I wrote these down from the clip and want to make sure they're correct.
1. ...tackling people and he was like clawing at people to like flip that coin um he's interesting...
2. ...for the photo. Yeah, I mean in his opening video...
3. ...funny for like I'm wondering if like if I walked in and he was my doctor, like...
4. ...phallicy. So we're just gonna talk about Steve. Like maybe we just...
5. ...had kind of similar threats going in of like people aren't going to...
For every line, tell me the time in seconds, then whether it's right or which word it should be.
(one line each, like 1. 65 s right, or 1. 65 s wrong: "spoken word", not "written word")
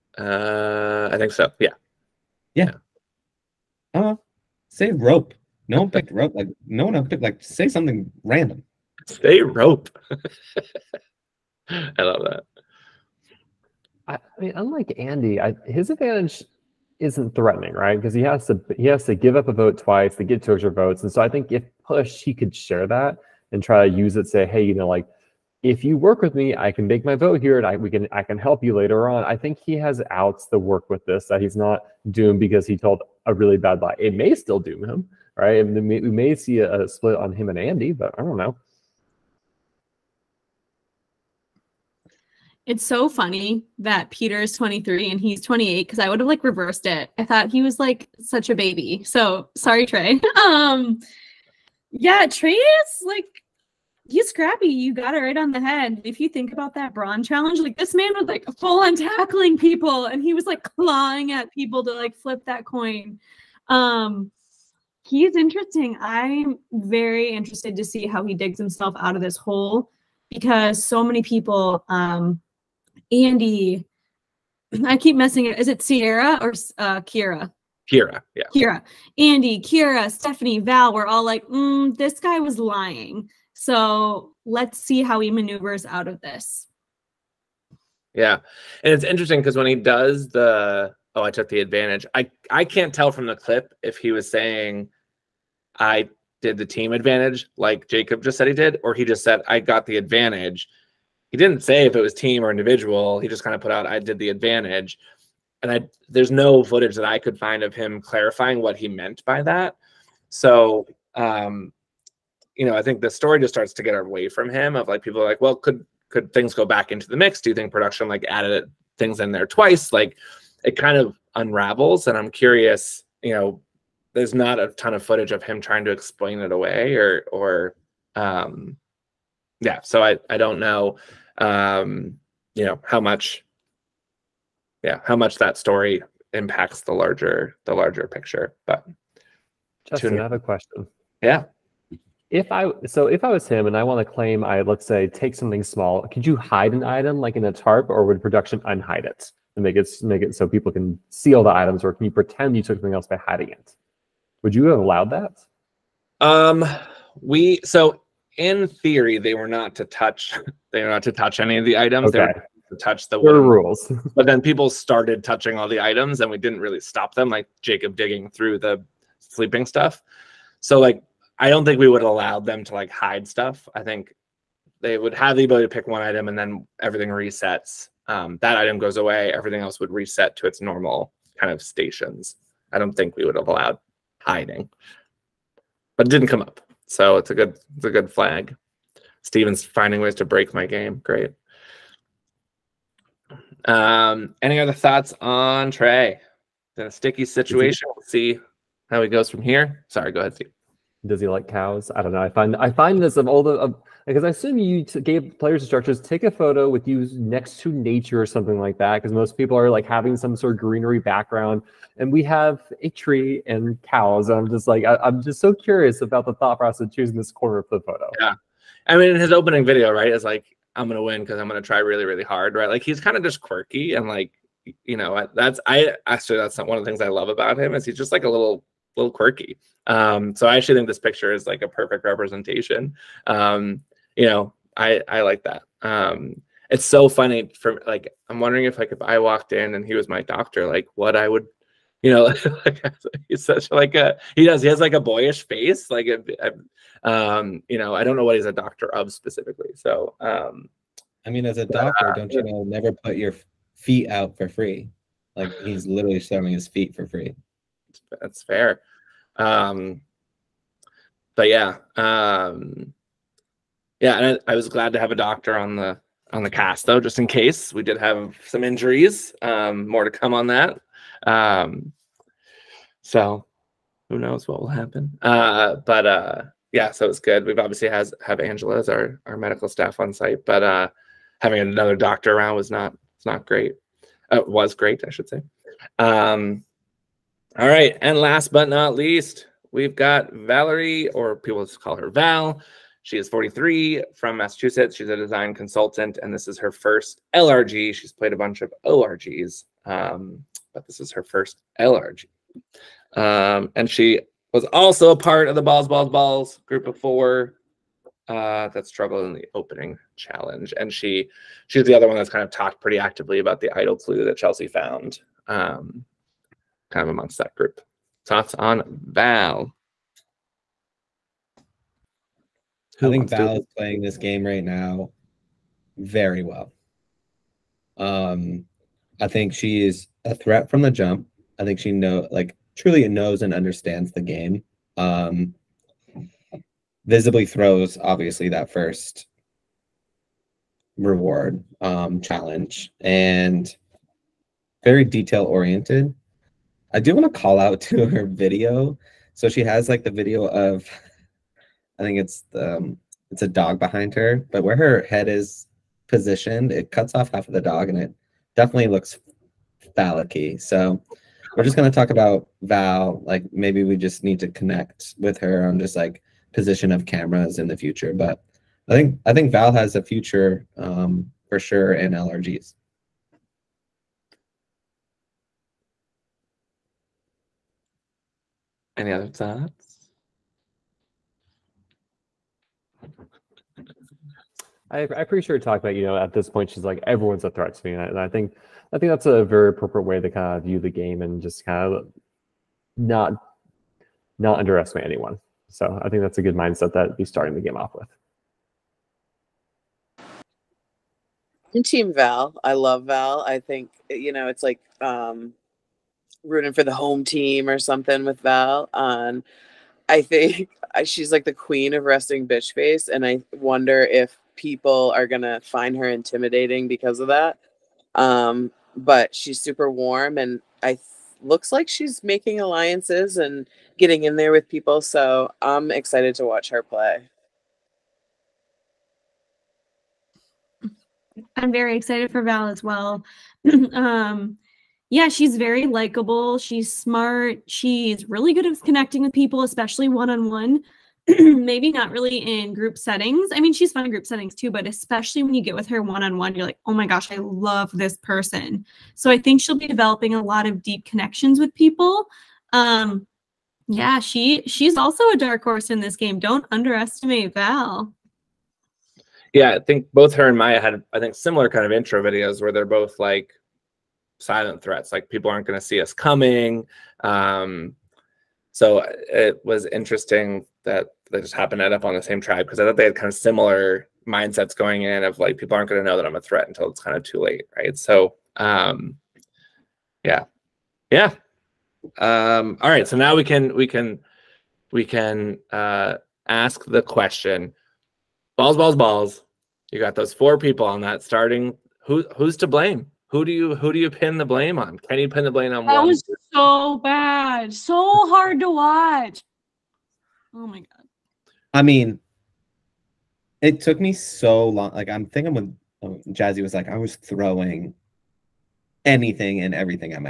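1. 58 s right
2. 217 s right
3. 237 s right
4. 359 s wrong: "Val", not "Steve"
5. 473 s wrong: "mindsets", not "threats".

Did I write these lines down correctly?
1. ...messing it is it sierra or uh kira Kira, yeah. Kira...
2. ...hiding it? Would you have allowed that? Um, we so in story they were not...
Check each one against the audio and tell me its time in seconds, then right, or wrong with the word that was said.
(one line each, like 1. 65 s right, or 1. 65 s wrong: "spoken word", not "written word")
1. 75 s right
2. 153 s wrong: "theory", not "story".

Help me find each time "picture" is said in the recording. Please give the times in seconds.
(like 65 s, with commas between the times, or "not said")
138 s, 230 s.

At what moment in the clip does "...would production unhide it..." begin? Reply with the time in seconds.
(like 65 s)
148 s.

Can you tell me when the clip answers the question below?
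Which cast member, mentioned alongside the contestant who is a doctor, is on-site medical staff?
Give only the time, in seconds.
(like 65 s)
278 s.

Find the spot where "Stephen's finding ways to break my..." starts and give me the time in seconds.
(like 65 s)
189 s.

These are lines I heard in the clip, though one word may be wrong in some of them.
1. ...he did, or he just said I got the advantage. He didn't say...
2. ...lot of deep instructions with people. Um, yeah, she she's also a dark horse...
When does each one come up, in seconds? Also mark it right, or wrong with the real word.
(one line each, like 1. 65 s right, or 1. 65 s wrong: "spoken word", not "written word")
1. 98 s right
2. 450 s wrong: "connections", not "instructions".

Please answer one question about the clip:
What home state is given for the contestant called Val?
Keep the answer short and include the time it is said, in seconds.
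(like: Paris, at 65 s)
Massachusetts, at 294 s.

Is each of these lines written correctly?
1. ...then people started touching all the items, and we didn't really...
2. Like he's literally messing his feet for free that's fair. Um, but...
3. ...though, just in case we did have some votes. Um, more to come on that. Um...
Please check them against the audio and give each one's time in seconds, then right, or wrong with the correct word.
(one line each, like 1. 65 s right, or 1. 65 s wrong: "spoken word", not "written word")
1. 164 s right
2. 255 s wrong: "showing", not "messing"
3. 266 s wrong: "injuries", not "votes".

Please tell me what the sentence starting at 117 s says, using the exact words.
Do you think production like added things in there twice?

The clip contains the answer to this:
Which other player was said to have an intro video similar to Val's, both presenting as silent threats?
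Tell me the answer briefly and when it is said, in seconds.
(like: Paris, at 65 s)
Maya, at 460 s.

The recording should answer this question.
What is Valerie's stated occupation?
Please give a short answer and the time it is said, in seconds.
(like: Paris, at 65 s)
design consultant, at 295 s.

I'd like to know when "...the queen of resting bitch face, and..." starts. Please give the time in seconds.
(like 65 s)
411 s.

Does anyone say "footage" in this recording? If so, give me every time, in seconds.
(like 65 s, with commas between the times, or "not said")
106 s, 125 s.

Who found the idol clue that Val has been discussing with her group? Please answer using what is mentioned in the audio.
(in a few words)
Chelsea.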